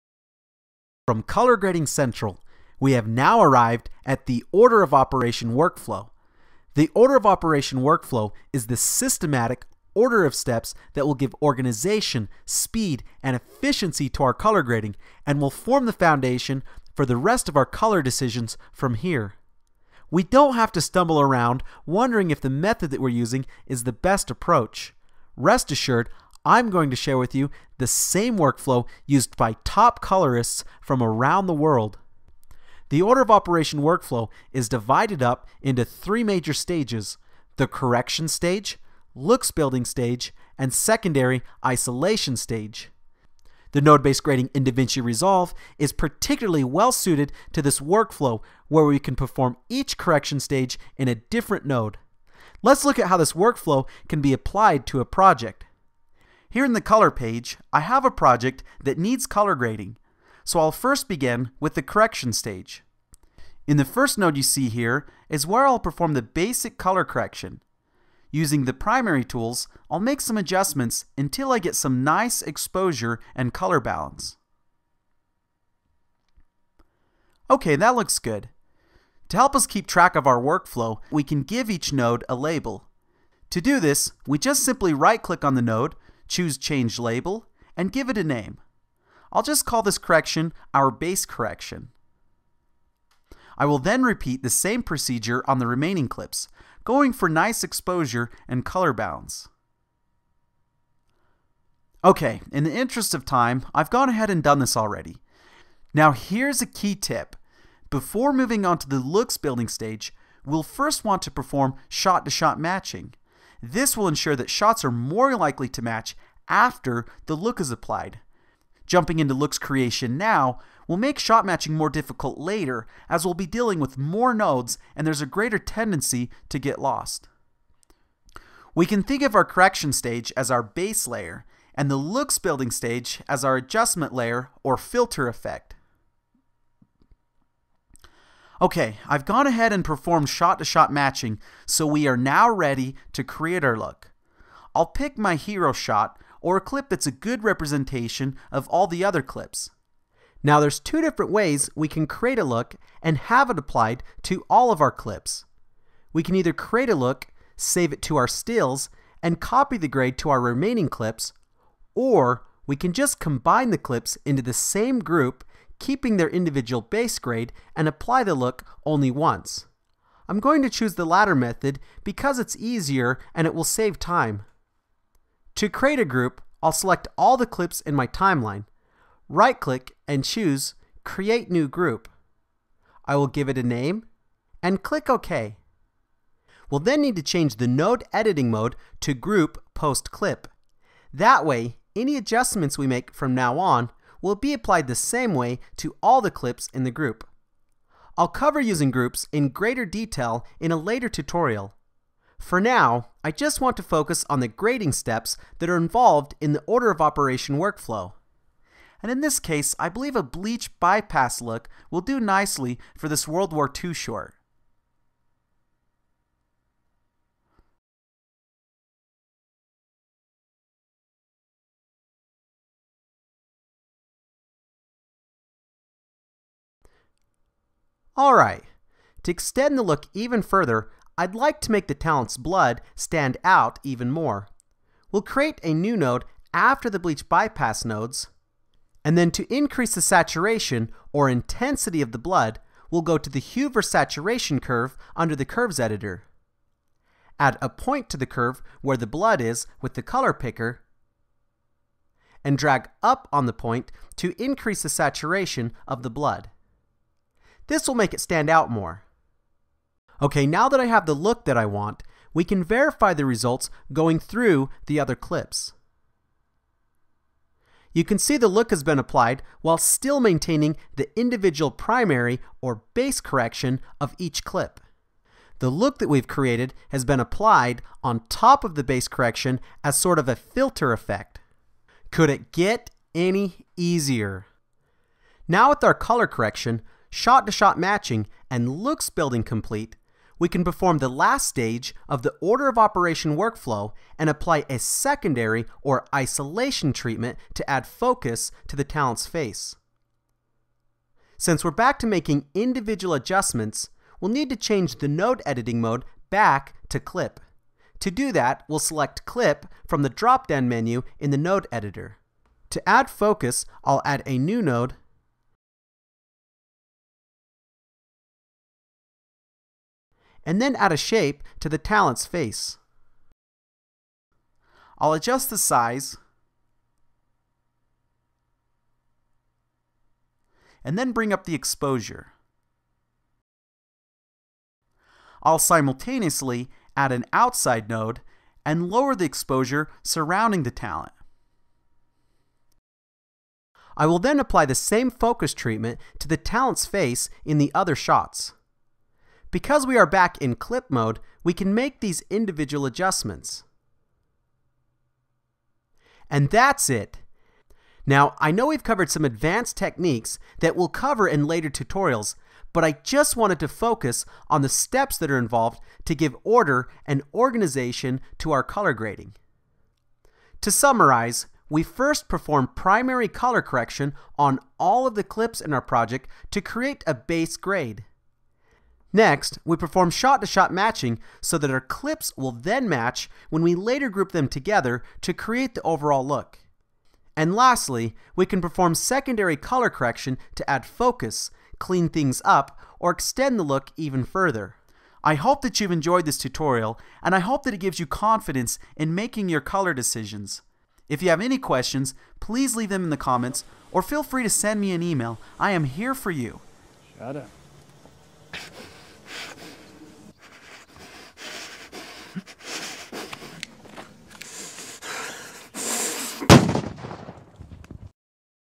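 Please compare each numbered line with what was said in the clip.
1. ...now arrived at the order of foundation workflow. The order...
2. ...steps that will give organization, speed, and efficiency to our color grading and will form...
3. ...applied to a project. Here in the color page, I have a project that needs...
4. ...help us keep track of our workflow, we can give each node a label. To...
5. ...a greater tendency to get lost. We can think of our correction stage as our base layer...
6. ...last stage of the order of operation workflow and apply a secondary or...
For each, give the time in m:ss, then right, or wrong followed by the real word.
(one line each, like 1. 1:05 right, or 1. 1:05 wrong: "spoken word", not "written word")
1. 0:03 wrong: "operation", not "foundation"
2. 0:10 right
3. 0:54 right
4. 1:19 right
5. 2:05 right
6. 4:51 right.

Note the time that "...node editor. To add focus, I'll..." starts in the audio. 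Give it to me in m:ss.
5:11.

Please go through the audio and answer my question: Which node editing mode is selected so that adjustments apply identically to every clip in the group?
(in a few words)
Group Post Clip.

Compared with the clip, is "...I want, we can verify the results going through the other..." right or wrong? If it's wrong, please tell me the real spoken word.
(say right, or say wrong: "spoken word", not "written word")
right.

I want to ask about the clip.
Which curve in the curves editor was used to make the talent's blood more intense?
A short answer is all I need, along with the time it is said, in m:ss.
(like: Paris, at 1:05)
hue versus saturation, at 4:03.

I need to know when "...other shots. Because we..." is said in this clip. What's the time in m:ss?
5:47.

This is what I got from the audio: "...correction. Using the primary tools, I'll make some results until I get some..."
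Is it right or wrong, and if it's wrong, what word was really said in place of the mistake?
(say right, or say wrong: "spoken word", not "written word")
wrong: "adjustments", not "results".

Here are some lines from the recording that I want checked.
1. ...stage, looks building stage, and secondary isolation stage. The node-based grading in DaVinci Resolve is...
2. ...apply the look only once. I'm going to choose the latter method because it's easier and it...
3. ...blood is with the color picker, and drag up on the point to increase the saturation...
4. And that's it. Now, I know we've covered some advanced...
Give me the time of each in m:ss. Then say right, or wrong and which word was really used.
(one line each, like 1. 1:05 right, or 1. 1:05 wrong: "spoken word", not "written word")
1. 0:38 right
2. 2:47 right
3. 4:09 right
4. 5:56 right.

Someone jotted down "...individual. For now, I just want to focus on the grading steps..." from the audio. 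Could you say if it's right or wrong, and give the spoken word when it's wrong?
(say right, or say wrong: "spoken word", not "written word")
wrong: "tutorial", not "individual".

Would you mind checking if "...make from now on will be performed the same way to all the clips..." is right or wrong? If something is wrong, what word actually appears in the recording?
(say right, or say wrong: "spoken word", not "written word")
wrong: "applied", not "performed".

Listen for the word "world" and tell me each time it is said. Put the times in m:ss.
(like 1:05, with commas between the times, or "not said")
0:31, 3:33.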